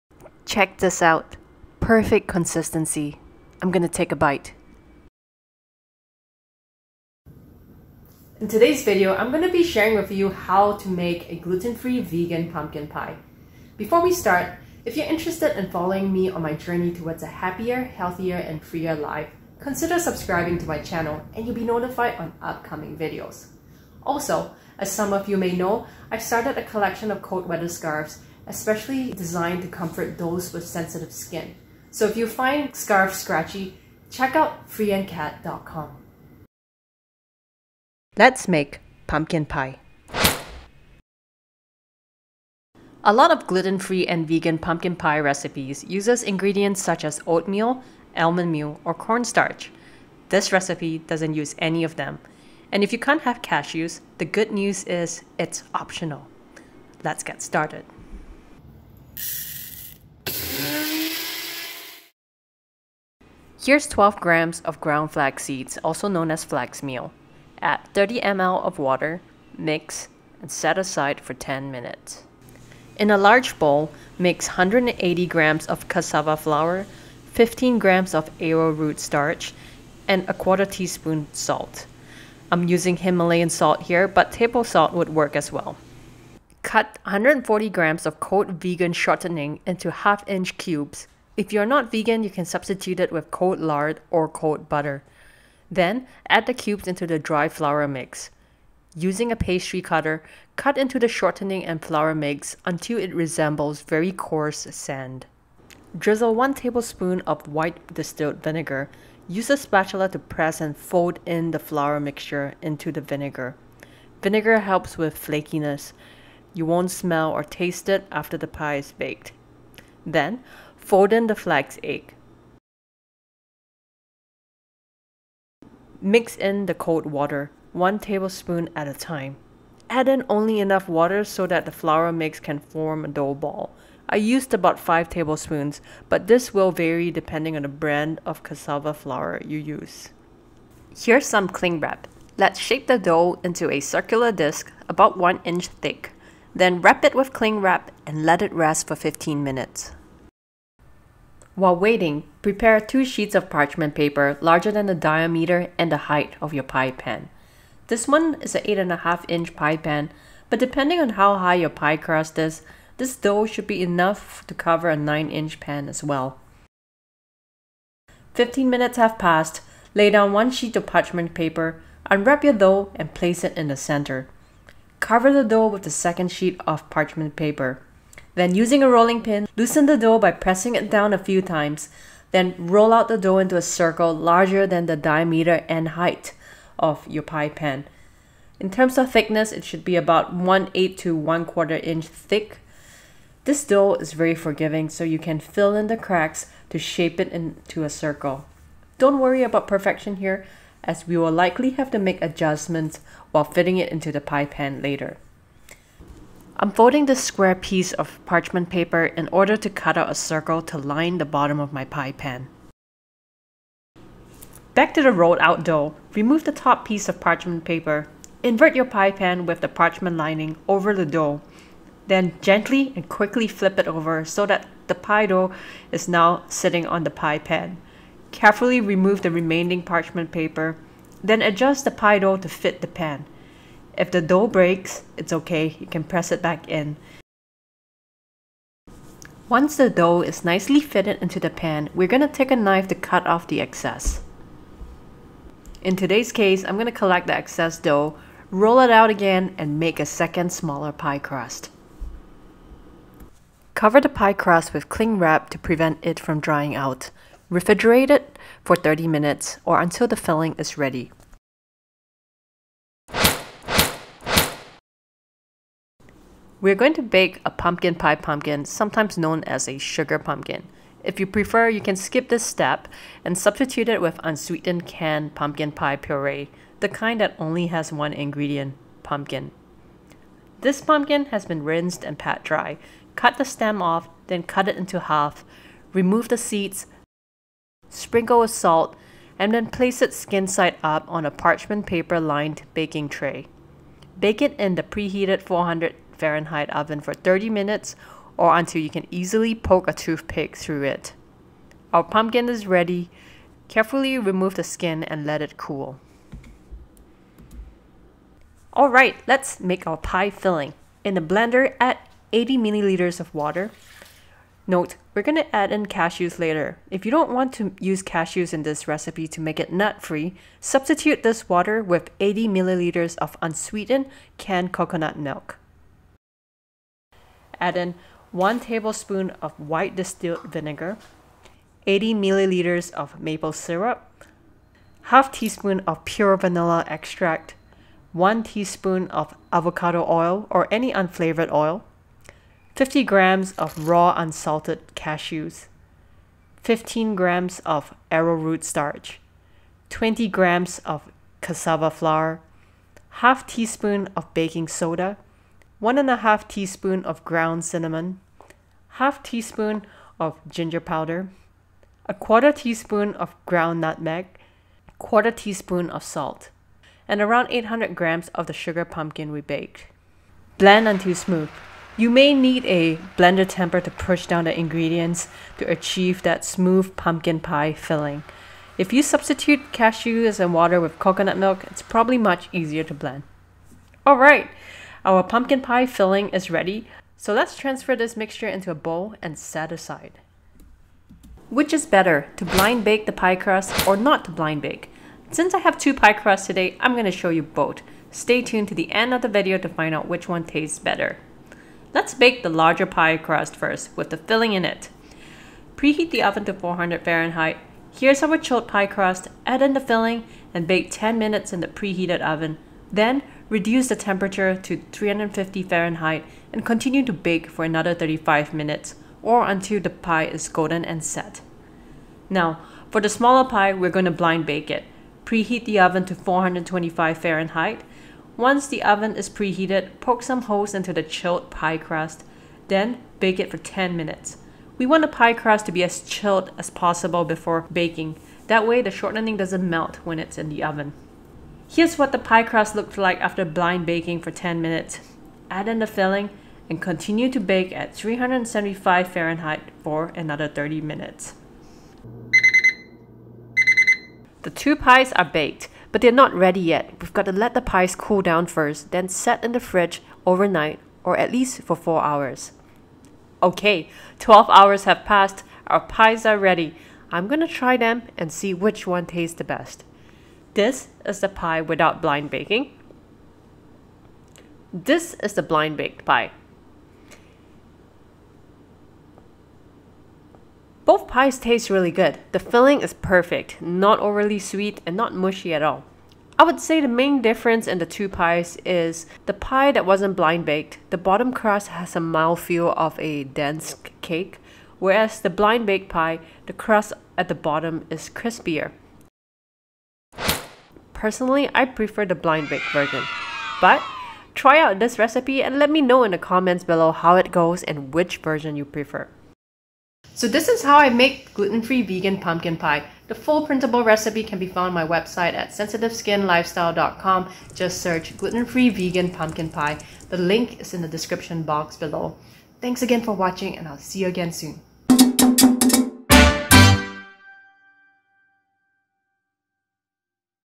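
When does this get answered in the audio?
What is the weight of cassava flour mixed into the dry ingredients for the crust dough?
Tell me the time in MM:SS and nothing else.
01:14.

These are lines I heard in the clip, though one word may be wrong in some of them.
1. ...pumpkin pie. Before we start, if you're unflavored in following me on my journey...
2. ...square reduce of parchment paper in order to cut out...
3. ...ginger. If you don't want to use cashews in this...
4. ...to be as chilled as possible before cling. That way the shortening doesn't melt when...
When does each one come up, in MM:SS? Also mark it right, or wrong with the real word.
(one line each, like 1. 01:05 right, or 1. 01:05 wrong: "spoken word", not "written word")
1. 00:12 wrong: "interested", not "unflavored"
2. 03:27 wrong: "piece", not "reduce"
3. 05:16 wrong: "later", not "ginger"
4. 07:15 wrong: "baking", not "cling".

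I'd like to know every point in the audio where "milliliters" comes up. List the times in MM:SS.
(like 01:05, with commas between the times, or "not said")
05:12, 05:22, 05:32.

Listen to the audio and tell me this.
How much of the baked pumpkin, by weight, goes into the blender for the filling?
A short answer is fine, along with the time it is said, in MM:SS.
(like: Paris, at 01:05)
800 grams, at 06:07.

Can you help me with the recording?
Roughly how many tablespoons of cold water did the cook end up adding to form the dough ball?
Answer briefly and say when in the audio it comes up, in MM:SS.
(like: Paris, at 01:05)
5 tablespoons, at 02:14.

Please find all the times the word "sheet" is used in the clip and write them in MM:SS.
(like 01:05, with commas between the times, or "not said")
02:33, 02:50, 02:56.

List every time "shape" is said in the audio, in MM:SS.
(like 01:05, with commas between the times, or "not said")
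02:22, 03:16.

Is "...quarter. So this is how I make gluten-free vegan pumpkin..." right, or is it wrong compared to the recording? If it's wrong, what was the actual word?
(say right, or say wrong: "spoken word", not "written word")
wrong: "prefer", not "quarter".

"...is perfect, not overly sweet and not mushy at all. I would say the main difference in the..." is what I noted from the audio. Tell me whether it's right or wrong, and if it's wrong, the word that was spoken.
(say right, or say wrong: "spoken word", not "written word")
right.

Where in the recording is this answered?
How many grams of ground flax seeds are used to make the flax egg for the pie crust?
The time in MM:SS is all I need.
01:03.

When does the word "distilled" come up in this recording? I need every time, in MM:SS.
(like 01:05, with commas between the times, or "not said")
01:47, 05:29.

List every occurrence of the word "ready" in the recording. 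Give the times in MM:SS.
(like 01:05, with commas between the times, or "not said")
04:20, 05:02, 06:26, 07:36, 07:46.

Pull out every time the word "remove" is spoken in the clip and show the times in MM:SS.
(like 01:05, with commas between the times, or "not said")
03:36, 03:48, 04:45, 05:04.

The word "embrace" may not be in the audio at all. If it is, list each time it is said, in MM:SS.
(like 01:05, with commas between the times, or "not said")
not said.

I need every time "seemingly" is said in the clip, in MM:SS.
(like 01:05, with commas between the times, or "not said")
not said.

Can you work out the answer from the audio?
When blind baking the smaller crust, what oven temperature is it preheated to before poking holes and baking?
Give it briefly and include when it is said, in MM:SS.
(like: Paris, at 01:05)
425 Fahrenheit, at 07:06.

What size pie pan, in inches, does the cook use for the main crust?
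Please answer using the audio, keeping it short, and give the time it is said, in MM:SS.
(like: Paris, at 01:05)
8.5 inch, at 02:38.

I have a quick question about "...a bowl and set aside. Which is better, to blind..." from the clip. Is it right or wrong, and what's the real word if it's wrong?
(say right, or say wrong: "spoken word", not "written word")
right.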